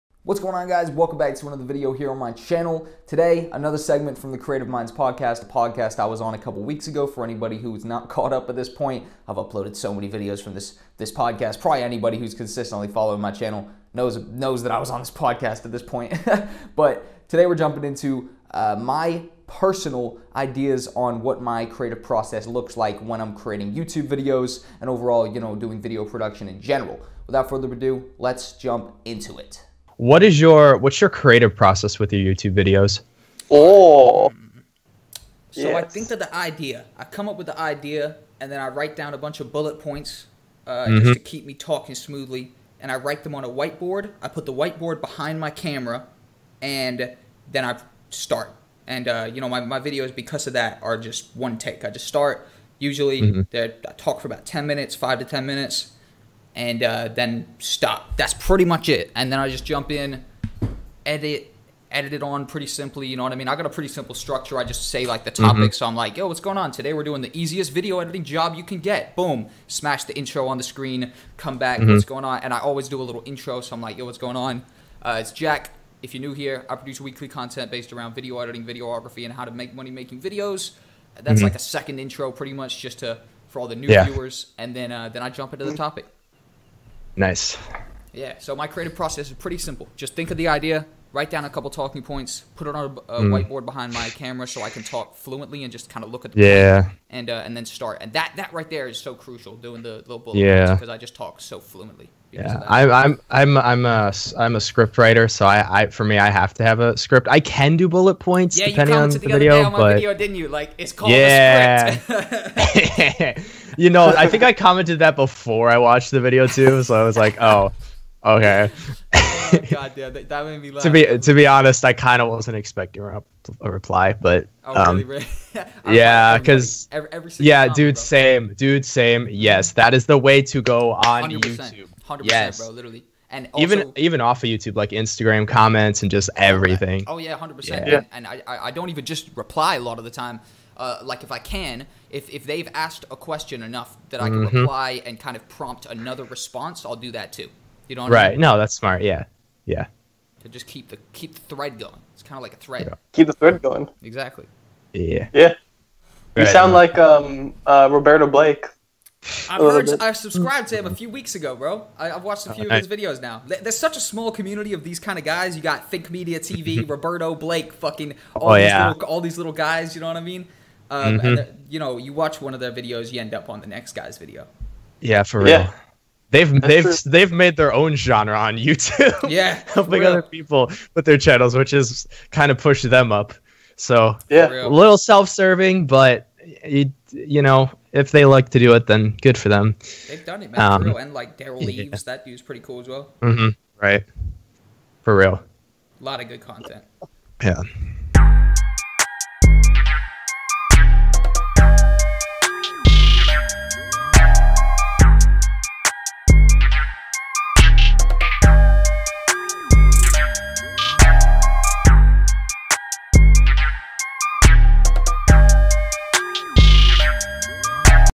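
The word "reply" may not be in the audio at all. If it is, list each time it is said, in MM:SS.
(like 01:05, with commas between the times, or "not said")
02:03, 02:19, 02:24.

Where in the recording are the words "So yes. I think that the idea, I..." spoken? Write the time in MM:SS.
00:35.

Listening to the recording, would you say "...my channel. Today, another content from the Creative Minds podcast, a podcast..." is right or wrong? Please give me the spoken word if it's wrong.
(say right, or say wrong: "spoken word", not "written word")
wrong: "segment", not "content".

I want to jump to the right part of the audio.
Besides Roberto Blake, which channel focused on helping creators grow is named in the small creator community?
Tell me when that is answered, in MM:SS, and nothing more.
02:45.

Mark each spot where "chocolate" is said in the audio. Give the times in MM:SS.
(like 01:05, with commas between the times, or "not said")
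not said.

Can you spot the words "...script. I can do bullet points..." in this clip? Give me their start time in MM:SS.
01:46.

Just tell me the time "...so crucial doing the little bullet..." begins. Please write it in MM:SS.
01:38.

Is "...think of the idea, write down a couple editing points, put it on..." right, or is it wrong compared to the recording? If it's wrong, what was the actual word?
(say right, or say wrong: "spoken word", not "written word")
wrong: "talking", not "editing".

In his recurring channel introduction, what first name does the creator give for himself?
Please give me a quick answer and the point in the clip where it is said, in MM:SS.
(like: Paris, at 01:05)
Jack, at 01:15.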